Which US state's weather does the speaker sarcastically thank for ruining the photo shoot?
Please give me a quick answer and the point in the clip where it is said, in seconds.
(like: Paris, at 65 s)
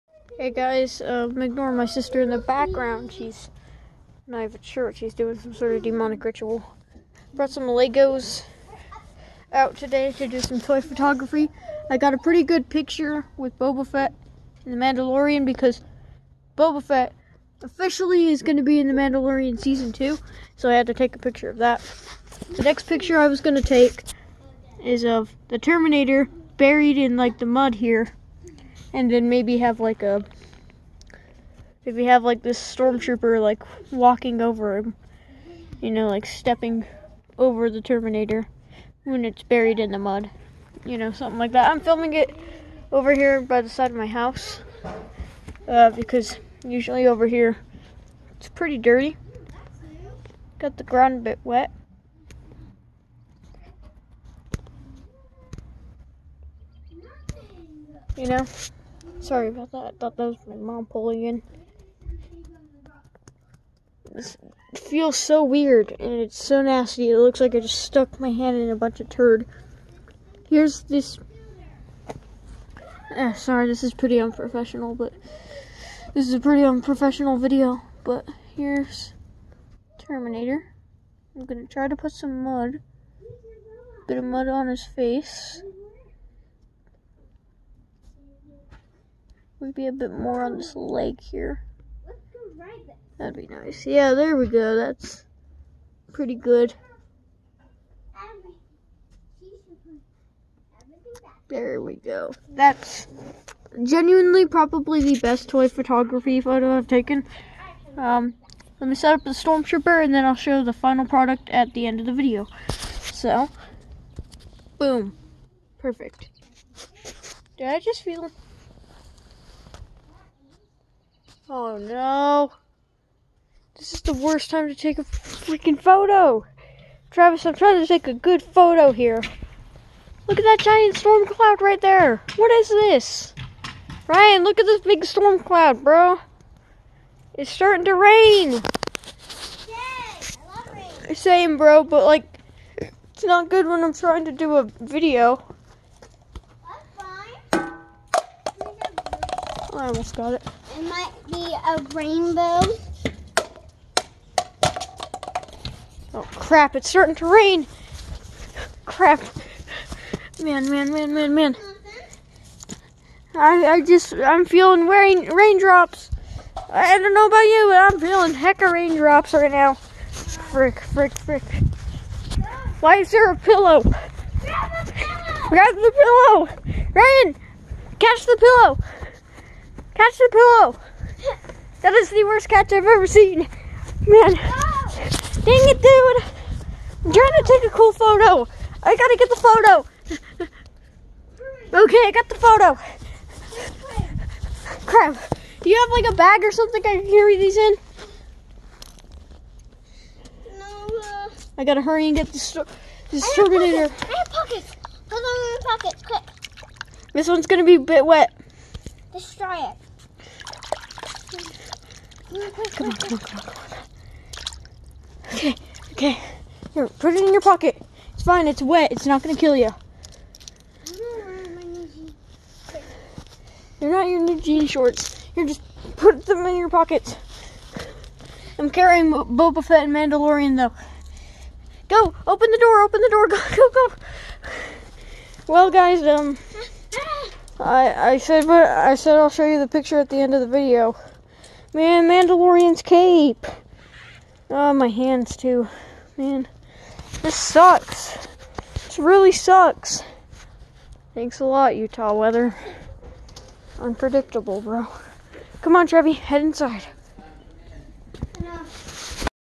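Utah, at 251 s.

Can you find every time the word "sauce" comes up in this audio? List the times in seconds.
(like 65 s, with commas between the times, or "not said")
not said.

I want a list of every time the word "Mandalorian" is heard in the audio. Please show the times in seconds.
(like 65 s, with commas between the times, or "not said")
14 s, 18 s, 229 s, 242 s.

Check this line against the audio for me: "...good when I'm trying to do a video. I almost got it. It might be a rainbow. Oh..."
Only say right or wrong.
right.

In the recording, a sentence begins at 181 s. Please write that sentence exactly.
That is the worst catch I've ever seen.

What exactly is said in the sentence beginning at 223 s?
They're not your new jean shorts.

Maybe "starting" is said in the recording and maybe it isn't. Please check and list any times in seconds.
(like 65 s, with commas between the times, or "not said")
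137 s, 156 s.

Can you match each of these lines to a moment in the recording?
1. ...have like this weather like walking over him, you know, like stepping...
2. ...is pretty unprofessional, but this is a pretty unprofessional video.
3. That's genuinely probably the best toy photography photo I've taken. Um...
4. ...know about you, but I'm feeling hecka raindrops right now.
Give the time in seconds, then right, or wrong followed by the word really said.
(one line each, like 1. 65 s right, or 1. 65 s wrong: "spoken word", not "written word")
1. 32 s wrong: "stormtrooper", not "weather"
2. 73 s right
3. 102 s right
4. 167 s right.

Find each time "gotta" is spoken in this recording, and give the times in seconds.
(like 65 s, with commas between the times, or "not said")
188 s, 201 s.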